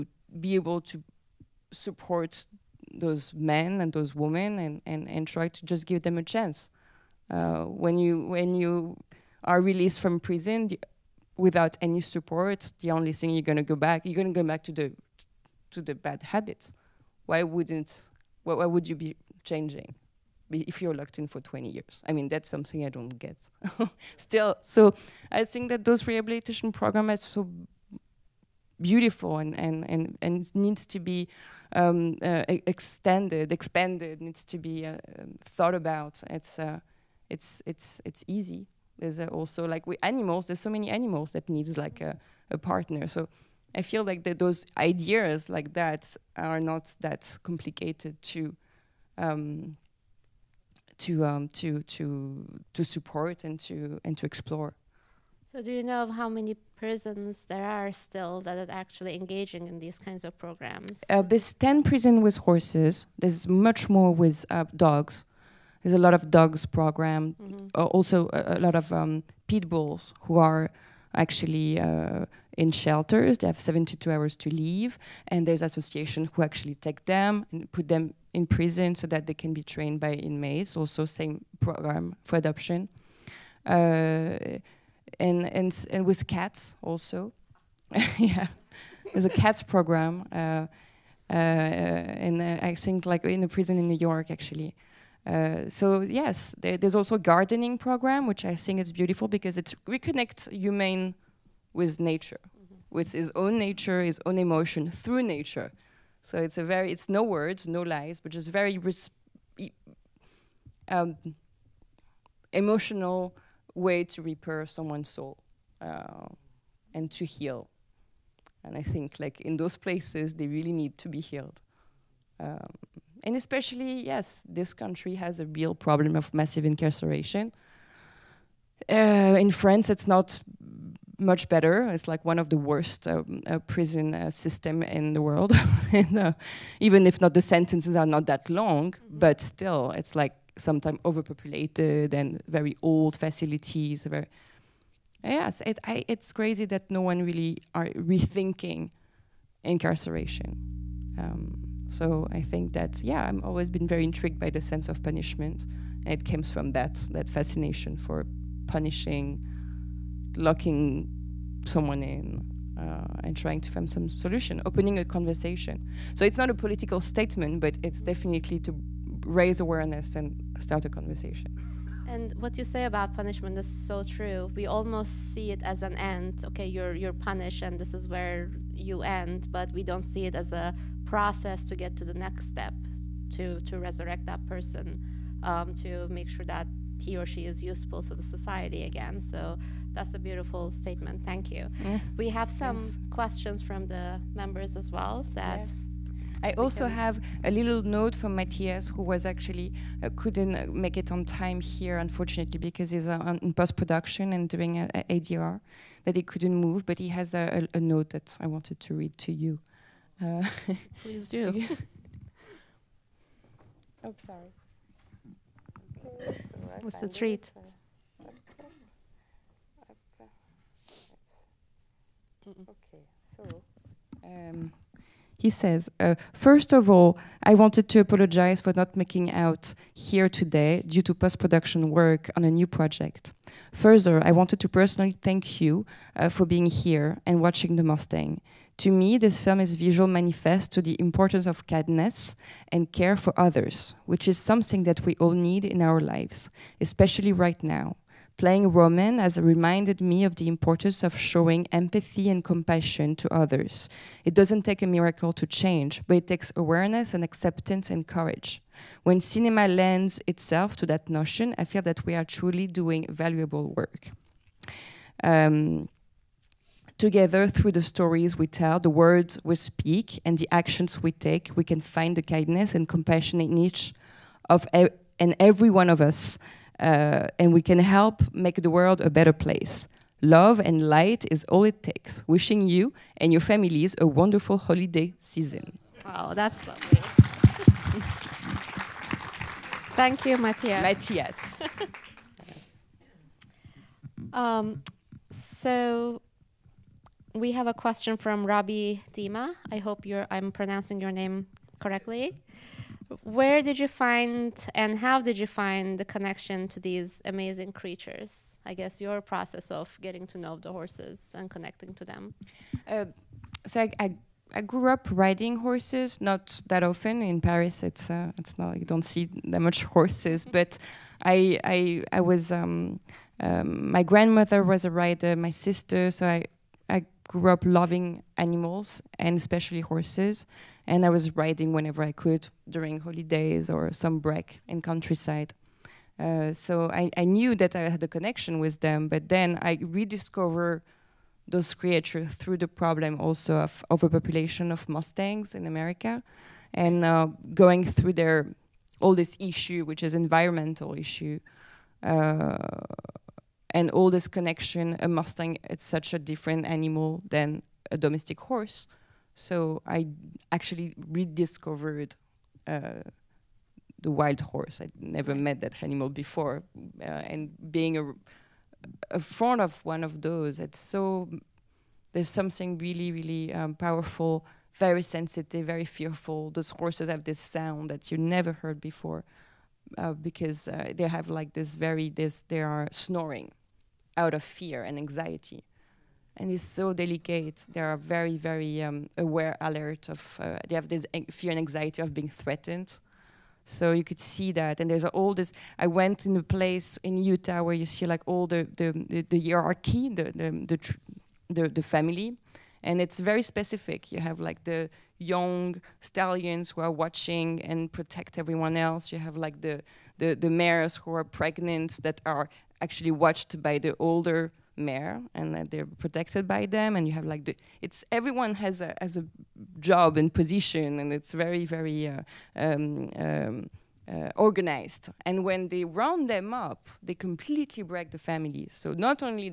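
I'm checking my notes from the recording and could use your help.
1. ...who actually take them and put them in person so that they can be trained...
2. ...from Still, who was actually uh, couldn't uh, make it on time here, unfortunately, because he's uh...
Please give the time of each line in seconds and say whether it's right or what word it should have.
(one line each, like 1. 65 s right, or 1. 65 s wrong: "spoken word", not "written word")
1. 76 s wrong: "prison", not "person"
2. 198 s wrong: "Matthias", not "Still".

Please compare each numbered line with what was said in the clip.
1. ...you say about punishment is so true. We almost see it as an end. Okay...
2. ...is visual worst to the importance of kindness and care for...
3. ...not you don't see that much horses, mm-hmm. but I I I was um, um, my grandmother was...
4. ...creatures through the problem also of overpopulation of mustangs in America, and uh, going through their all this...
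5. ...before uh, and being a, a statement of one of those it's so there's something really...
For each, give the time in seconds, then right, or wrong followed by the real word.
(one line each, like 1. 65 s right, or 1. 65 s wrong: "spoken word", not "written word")
1. 172 s right
2. 239 s wrong: "manifest", not "worst"
3. 318 s right
4. 341 s right
5. 366 s wrong: "front", not "statement".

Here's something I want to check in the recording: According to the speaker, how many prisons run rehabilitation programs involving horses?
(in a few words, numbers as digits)
10.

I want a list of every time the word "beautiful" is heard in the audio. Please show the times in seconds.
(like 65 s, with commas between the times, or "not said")
28 s, 98 s, 190 s.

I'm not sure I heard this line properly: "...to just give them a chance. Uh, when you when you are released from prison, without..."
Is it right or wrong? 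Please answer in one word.
right.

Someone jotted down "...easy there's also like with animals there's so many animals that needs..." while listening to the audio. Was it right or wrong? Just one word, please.
right.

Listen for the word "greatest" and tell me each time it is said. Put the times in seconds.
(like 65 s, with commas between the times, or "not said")
not said.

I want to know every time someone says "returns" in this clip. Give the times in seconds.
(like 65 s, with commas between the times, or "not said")
not said.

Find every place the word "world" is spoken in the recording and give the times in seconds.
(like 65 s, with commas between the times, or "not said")
135 s, 278 s.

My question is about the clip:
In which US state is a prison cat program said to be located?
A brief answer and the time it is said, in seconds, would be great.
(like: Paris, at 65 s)
New York, at 93 s.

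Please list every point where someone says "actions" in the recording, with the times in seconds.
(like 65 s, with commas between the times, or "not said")
270 s.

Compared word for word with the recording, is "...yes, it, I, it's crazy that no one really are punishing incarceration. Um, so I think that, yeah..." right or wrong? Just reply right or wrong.
wrong.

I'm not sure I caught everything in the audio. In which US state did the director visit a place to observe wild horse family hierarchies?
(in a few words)
Utah.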